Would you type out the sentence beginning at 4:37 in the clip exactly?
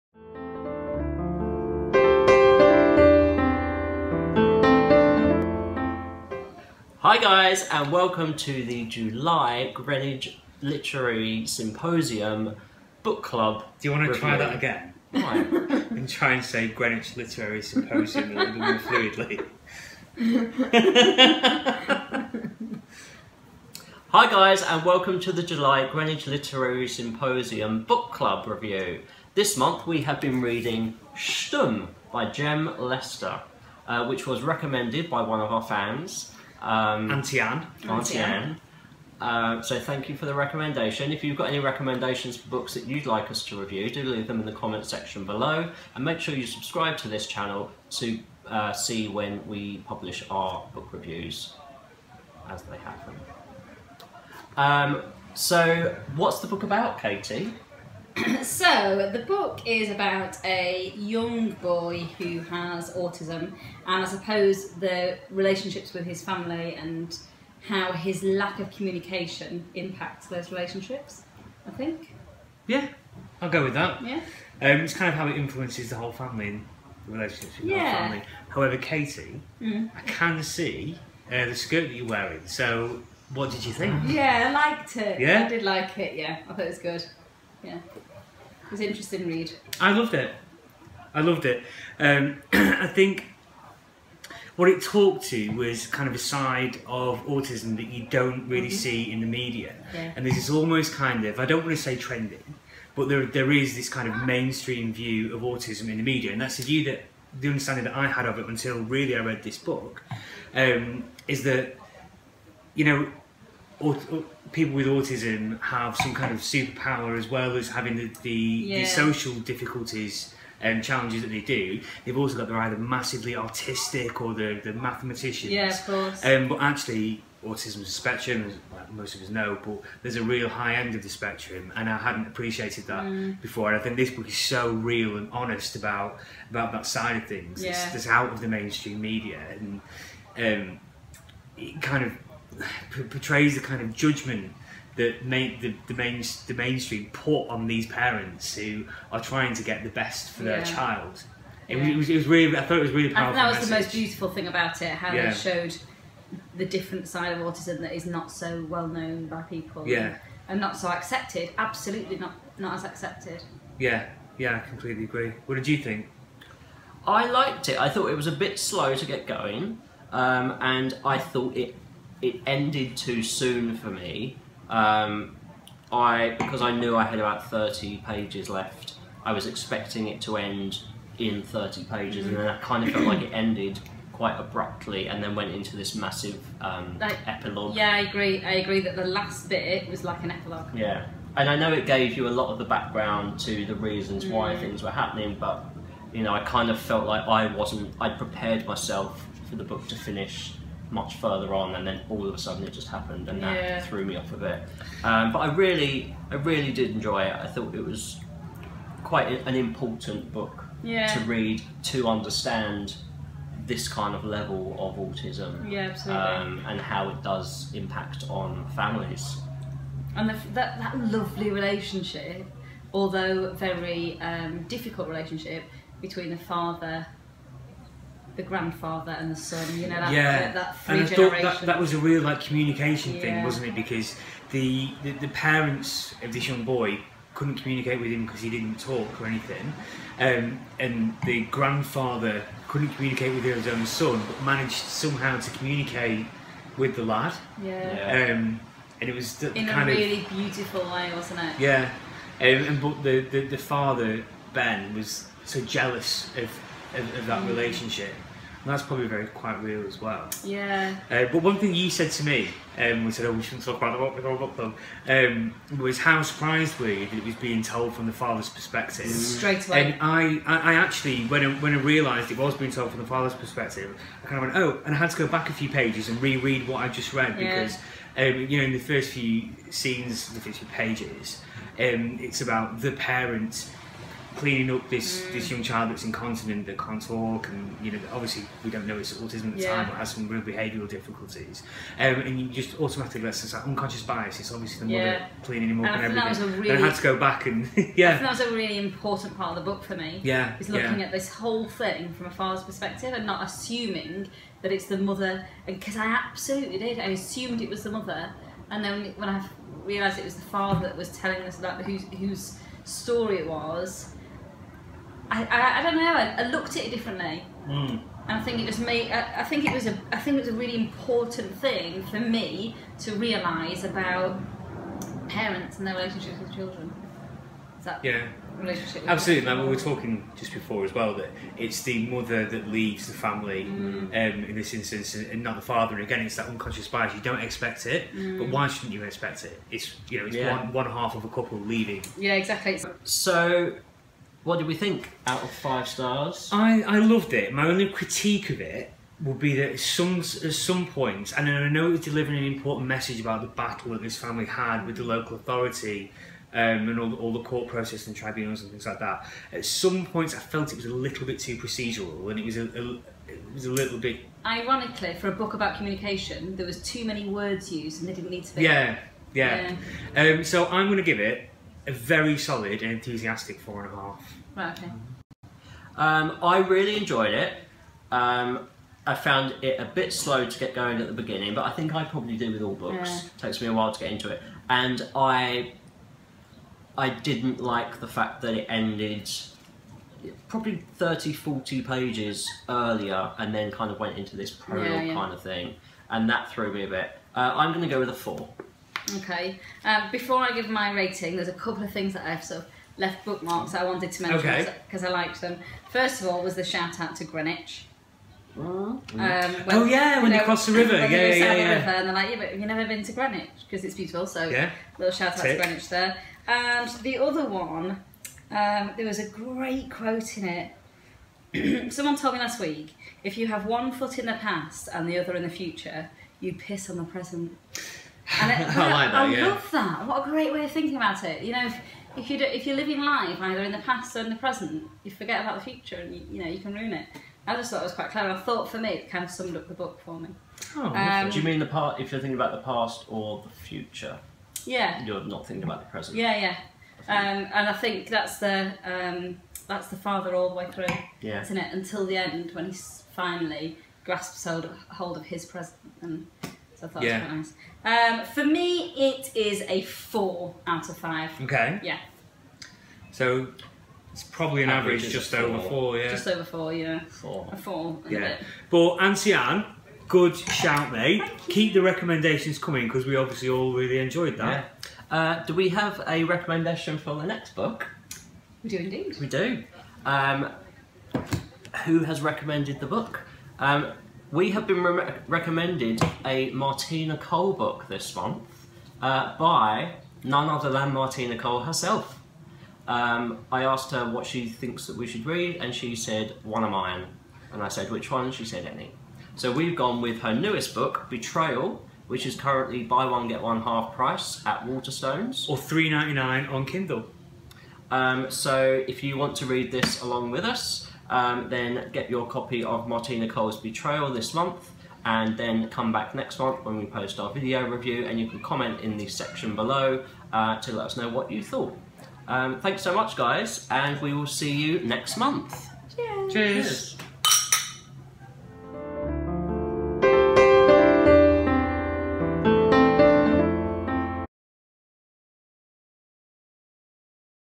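because, um, you know, in the first few scenes, the first few pages, um, it's about the parents cleaning up this mm.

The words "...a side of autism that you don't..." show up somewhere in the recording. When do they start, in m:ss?
1:36.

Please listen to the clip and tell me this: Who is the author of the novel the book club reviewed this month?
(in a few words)
Jem Lester.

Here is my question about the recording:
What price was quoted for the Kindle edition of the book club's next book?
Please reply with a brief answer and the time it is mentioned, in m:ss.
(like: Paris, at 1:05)
3.99, at 8:25.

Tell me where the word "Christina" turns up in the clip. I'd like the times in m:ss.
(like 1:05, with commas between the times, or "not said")
not said.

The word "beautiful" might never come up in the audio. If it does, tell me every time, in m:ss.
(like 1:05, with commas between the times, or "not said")
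2:33, 4:10, 6:53.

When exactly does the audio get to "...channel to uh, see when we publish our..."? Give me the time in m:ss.
0:47.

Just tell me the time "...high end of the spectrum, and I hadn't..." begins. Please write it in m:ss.
2:10.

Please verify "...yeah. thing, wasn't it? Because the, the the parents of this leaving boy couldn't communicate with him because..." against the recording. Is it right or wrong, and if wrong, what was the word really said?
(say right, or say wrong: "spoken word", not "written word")
wrong: "young", not "leaving".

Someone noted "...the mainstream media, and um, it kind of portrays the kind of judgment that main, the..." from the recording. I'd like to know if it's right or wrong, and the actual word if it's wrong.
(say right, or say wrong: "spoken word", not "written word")
right.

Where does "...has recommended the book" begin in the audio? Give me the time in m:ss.
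8:01.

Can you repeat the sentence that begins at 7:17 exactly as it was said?
I just thought it was quite clever.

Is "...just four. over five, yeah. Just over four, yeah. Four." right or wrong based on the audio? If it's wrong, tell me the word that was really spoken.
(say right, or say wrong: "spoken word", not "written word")
wrong: "four", not "five".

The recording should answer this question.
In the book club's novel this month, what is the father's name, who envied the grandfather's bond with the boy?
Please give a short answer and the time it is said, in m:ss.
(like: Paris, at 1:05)
Ben, at 4:14.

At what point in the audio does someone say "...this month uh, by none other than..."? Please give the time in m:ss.
8:07.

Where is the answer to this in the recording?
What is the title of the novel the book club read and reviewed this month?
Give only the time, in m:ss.
0:31.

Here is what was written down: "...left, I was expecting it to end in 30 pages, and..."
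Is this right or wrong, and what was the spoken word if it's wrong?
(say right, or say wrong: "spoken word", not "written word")
right.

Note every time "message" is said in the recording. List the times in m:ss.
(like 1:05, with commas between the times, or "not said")
2:33, 5:52.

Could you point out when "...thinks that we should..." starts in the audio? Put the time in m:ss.
8:14.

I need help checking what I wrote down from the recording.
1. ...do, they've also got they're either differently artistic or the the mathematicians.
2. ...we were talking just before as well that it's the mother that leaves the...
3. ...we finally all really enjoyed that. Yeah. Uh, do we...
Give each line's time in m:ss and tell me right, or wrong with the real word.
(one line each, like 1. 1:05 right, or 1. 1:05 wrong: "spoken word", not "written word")
1. 2:01 wrong: "massively", not "differently"
2. 5:29 right
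3. 7:53 wrong: "obviously", not "finally".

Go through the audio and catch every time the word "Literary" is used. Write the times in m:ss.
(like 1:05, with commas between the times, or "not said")
0:10, 0:17, 0:26.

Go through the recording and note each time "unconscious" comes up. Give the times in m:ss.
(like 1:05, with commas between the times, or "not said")
4:53, 5:36.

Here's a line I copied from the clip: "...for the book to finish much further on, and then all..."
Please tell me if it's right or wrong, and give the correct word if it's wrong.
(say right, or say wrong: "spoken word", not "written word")
right.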